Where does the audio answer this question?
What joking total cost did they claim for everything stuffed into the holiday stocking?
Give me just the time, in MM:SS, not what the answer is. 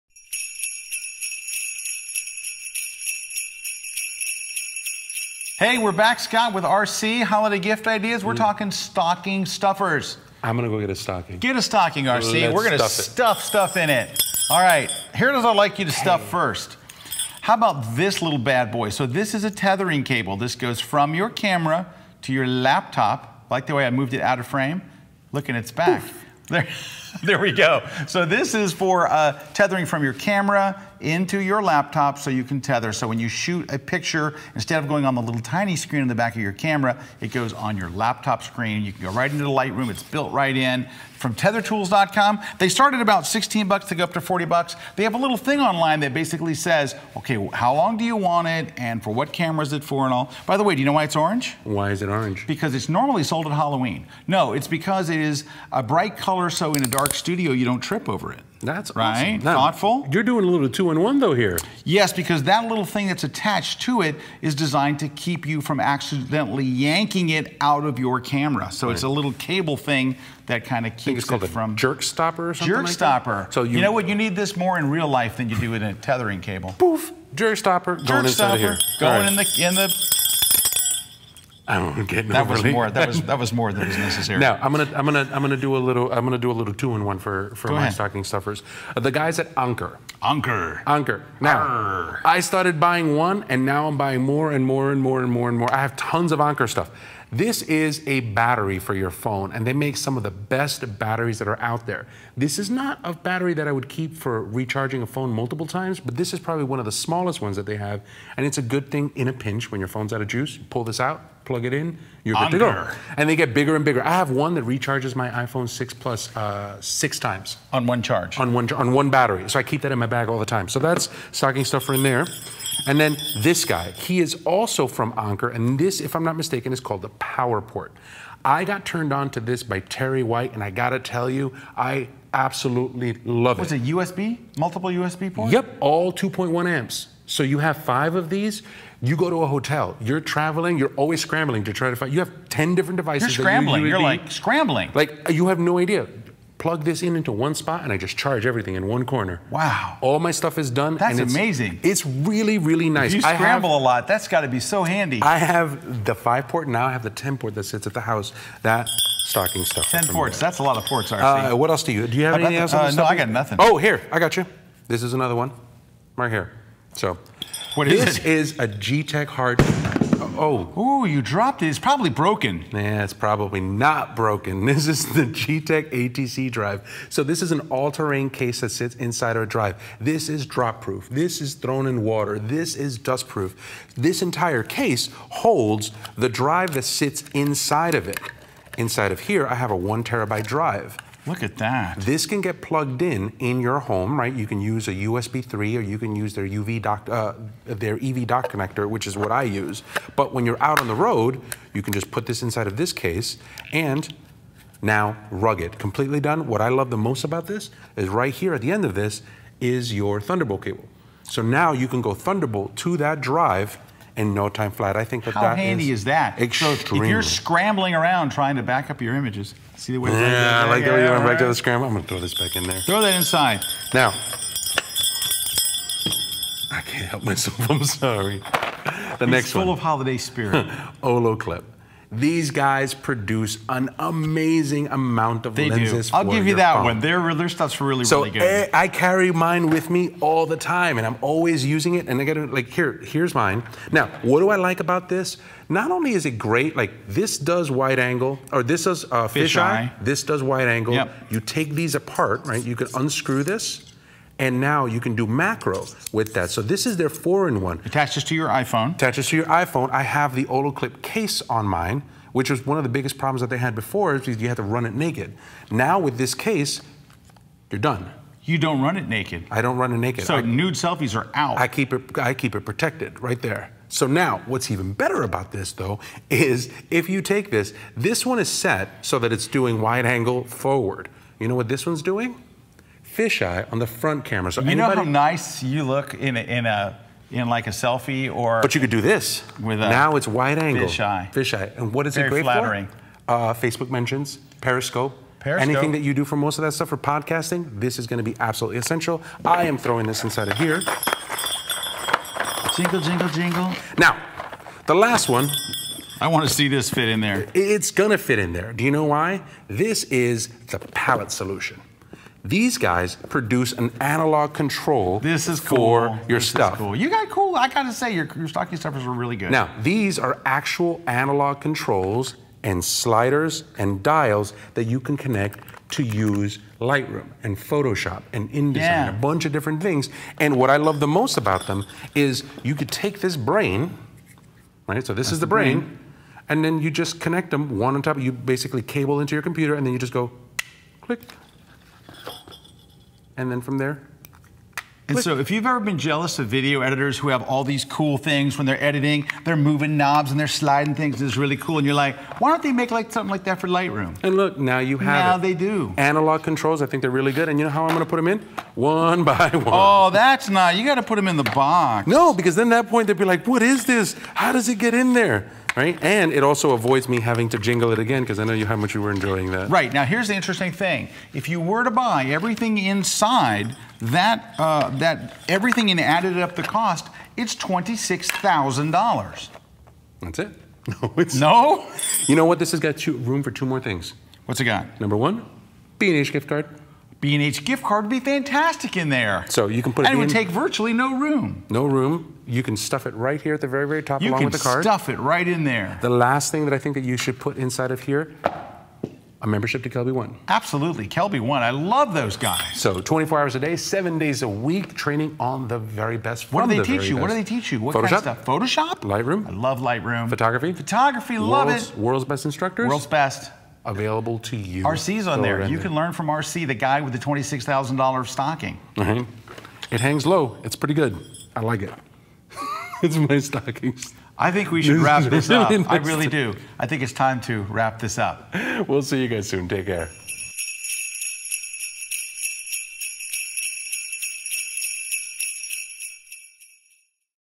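06:17.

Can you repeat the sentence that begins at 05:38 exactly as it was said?
You basically cable into your computer, and then you just go click and then from there.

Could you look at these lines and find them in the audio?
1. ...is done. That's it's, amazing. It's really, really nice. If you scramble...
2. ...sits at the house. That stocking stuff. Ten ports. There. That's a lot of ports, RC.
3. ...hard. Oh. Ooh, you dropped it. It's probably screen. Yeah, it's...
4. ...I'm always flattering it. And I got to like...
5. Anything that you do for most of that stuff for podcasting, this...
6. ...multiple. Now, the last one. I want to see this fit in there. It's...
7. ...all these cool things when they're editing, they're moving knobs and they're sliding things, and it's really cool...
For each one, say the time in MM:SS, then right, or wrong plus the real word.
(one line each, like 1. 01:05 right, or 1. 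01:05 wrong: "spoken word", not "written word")
1. 02:30 right
2. 02:37 right
3. 02:49 wrong: "broken", not "screen"
4. 04:01 wrong: "using", not "flattering"
5. 04:55 right
6. 05:03 wrong: "jingle", not "multiple"
7. 05:47 right.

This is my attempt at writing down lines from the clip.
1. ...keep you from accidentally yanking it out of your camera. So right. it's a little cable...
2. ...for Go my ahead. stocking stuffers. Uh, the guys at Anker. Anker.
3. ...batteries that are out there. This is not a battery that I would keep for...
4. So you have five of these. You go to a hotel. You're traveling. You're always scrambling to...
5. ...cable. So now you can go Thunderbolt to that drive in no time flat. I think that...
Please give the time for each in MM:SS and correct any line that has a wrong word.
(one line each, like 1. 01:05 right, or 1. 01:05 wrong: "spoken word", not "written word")
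1. 01:05 right
2. 01:27 right
3. 01:40 right
4. 02:17 right
5. 03:30 right.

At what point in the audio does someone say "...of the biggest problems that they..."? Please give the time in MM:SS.
04:22.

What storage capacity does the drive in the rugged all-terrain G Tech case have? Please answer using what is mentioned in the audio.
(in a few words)
1 terabyte.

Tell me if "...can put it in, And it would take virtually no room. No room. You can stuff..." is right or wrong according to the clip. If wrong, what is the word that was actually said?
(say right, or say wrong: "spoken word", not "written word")
right.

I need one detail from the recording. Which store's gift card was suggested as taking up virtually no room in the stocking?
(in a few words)
B&H.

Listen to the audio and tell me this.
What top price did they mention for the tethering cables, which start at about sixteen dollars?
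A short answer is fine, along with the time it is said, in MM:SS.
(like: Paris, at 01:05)
$40, at 00:44.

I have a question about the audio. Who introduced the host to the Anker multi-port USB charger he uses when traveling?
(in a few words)
Terry White.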